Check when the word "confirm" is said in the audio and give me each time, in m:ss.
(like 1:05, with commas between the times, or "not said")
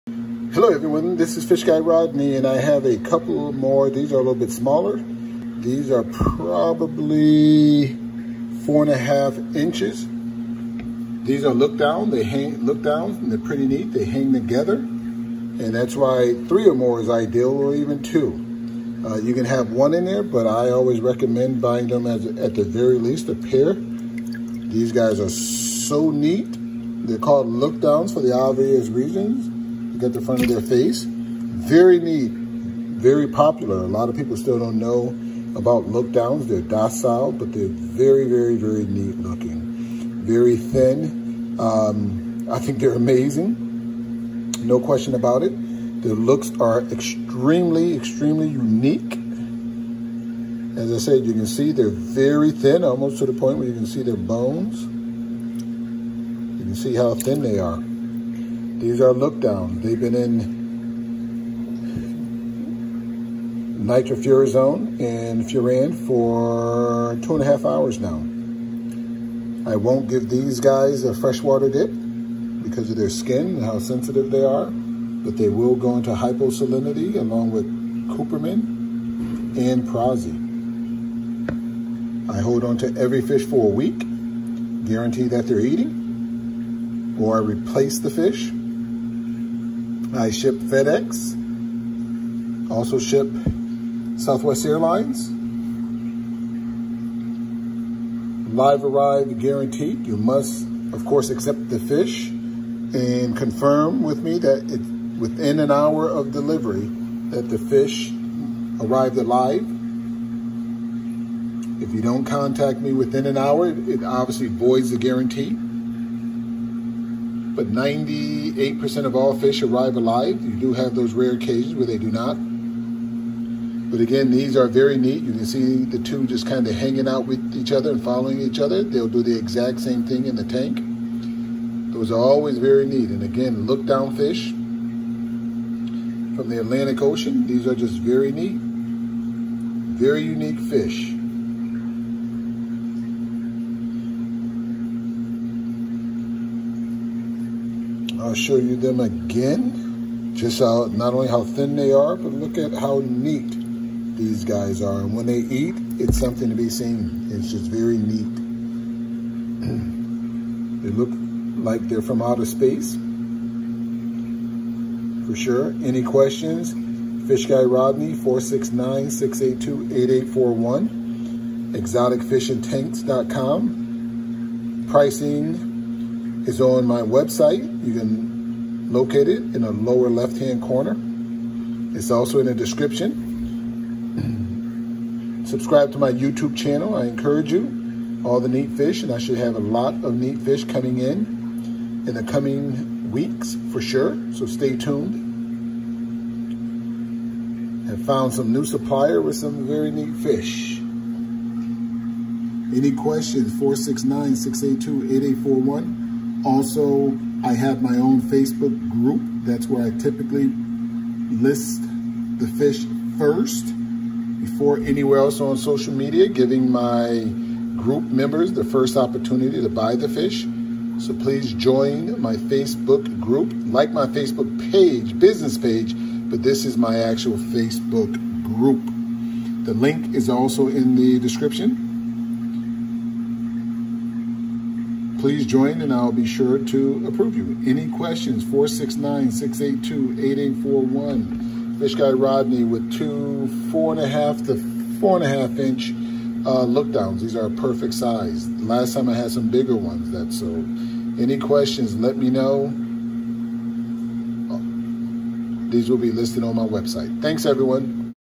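1:43.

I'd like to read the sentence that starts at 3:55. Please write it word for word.
Please join and I'll be sure to approve you.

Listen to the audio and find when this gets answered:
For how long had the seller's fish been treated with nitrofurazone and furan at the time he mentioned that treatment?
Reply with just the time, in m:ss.
1:07.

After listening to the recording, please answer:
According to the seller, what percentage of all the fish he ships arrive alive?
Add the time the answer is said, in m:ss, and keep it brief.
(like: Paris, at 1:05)
98%, at 1:57.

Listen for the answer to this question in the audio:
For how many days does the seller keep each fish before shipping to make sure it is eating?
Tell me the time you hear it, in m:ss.
1:23.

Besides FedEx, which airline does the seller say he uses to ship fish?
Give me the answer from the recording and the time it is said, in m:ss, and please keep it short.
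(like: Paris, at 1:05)
Southwest Airlines, at 1:34.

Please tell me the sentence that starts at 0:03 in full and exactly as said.
These are a little bit smaller.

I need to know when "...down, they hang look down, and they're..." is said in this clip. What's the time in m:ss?
0:11.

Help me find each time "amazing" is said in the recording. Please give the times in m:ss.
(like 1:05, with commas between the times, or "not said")
0:42.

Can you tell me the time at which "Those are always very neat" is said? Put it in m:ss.
2:11.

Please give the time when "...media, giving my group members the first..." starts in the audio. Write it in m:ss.
3:35.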